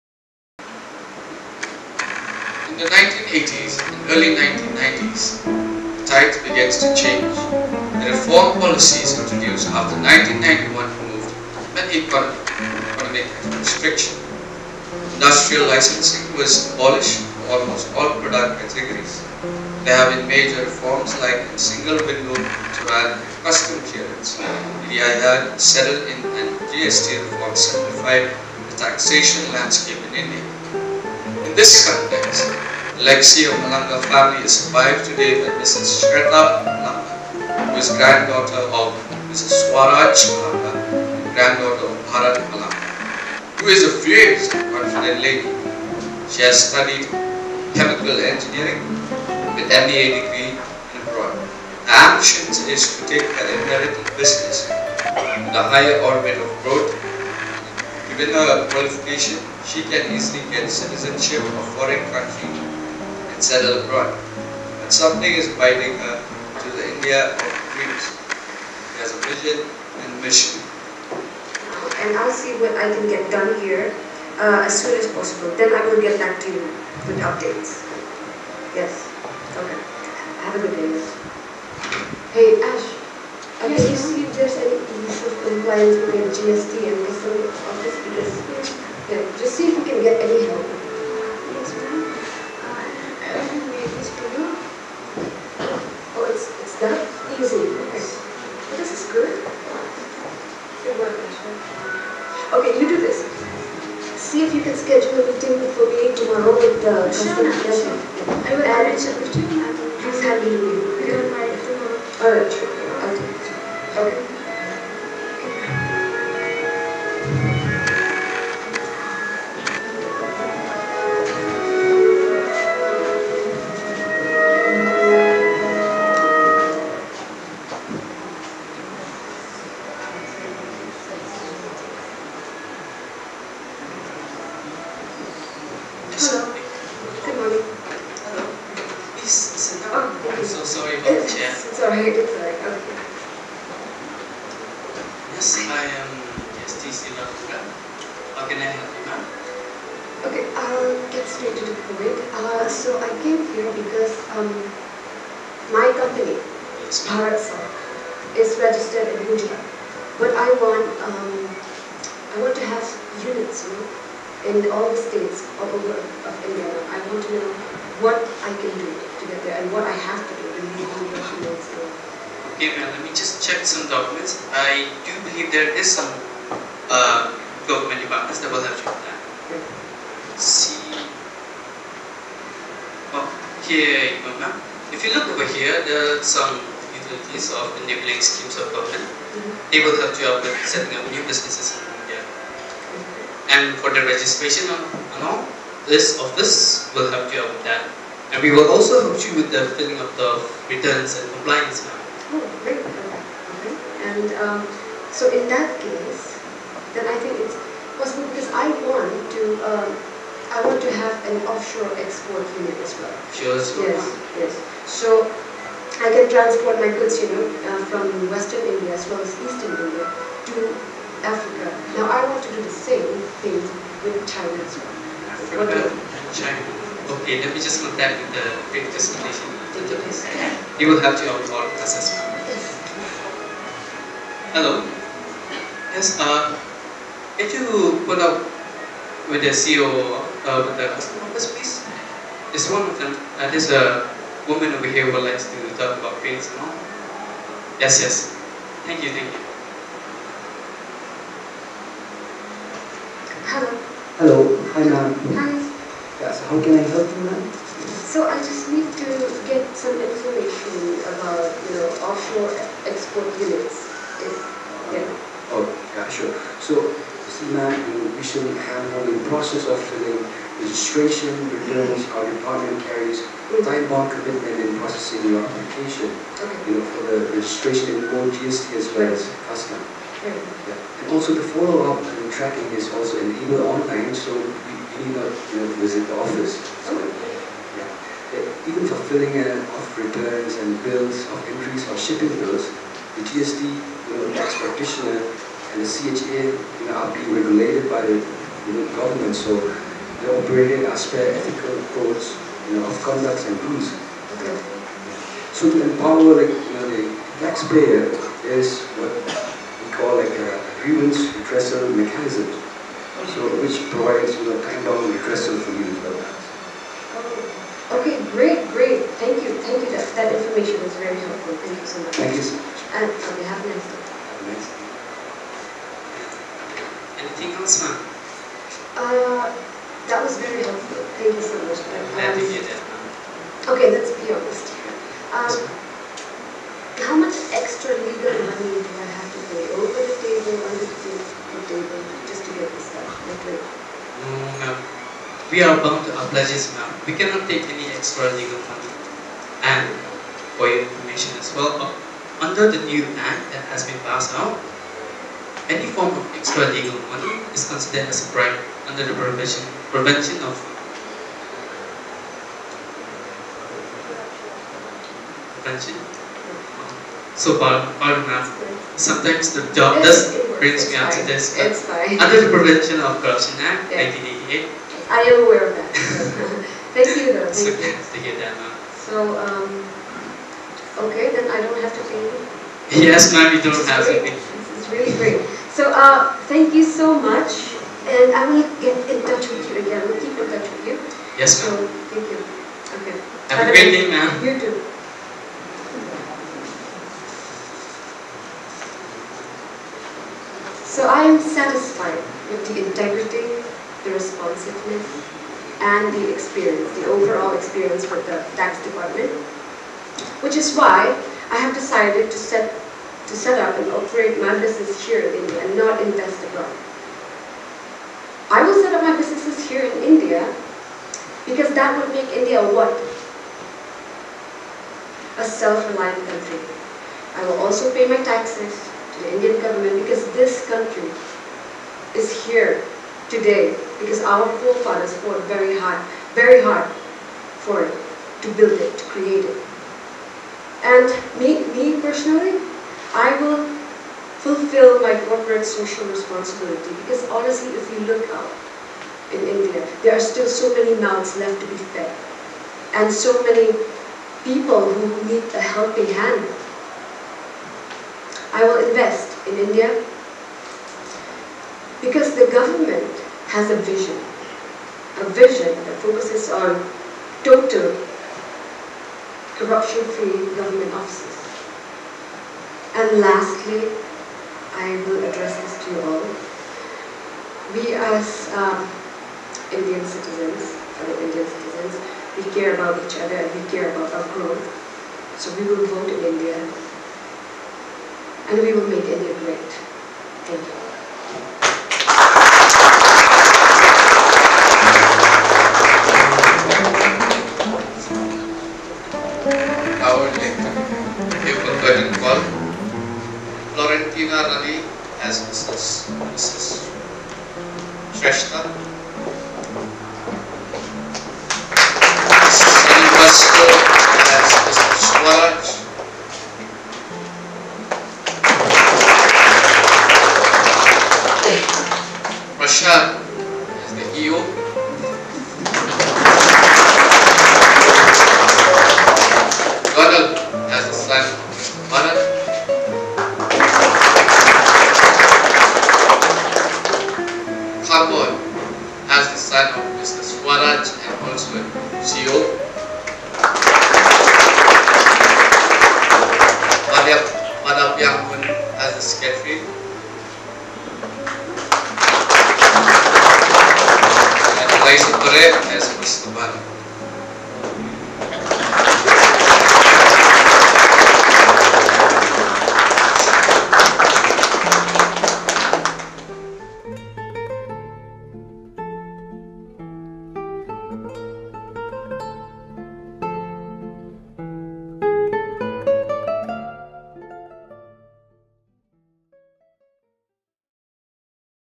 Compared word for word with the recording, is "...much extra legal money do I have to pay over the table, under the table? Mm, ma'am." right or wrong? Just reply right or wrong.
right.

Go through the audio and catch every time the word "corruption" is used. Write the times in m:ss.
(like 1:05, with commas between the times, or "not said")
6:13, 7:49.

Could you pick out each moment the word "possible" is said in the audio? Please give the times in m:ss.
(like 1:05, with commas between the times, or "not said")
1:15, 3:27.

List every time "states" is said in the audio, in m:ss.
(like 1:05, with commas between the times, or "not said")
2:44.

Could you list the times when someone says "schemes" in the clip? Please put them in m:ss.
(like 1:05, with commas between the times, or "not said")
3:08.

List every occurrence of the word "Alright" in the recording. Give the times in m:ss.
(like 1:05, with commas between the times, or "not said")
1:52.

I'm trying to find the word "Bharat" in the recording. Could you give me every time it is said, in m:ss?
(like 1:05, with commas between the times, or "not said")
0:42.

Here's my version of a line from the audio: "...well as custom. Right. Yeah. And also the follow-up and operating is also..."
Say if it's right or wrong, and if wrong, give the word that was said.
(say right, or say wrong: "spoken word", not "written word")
wrong: "tracking", not "operating".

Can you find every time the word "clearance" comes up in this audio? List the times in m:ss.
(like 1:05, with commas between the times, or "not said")
0:23.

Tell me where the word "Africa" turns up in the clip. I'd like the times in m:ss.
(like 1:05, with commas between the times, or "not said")
3:41, 3:45.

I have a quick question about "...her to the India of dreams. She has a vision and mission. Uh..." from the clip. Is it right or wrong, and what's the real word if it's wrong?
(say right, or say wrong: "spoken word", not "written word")
right.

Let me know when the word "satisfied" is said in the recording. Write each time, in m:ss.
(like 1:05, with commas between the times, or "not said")
6:41.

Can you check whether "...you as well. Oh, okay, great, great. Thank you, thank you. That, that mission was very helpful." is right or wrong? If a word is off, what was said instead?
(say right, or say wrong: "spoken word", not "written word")
wrong: "information", not "mission".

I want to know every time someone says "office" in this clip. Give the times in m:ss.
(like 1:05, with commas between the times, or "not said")
1:27, 3:16, 4:01, 4:46, 7:50.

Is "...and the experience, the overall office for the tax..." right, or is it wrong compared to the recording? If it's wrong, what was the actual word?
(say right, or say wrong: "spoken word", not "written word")
wrong: "experience", not "office".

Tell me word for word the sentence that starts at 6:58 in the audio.
I will set up my businesses here in India because that would make India what?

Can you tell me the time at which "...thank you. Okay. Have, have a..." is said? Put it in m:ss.
6:32.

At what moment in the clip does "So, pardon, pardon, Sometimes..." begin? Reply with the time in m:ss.
6:07.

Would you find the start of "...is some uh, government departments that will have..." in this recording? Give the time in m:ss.
2:55.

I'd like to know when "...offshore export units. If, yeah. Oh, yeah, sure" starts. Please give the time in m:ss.
4:22.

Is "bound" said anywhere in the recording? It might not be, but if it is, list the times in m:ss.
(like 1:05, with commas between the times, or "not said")
4:33, 5:45.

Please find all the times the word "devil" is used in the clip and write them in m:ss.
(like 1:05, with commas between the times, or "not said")
not said.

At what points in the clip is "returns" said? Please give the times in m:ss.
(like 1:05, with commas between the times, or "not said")
3:20, 4:31, 4:49.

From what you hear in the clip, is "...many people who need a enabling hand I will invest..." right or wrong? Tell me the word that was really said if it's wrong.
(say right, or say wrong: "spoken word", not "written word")
wrong: "helping", not "enabling".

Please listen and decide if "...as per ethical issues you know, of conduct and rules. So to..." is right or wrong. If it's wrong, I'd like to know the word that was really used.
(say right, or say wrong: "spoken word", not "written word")
wrong: "codes", not "issues".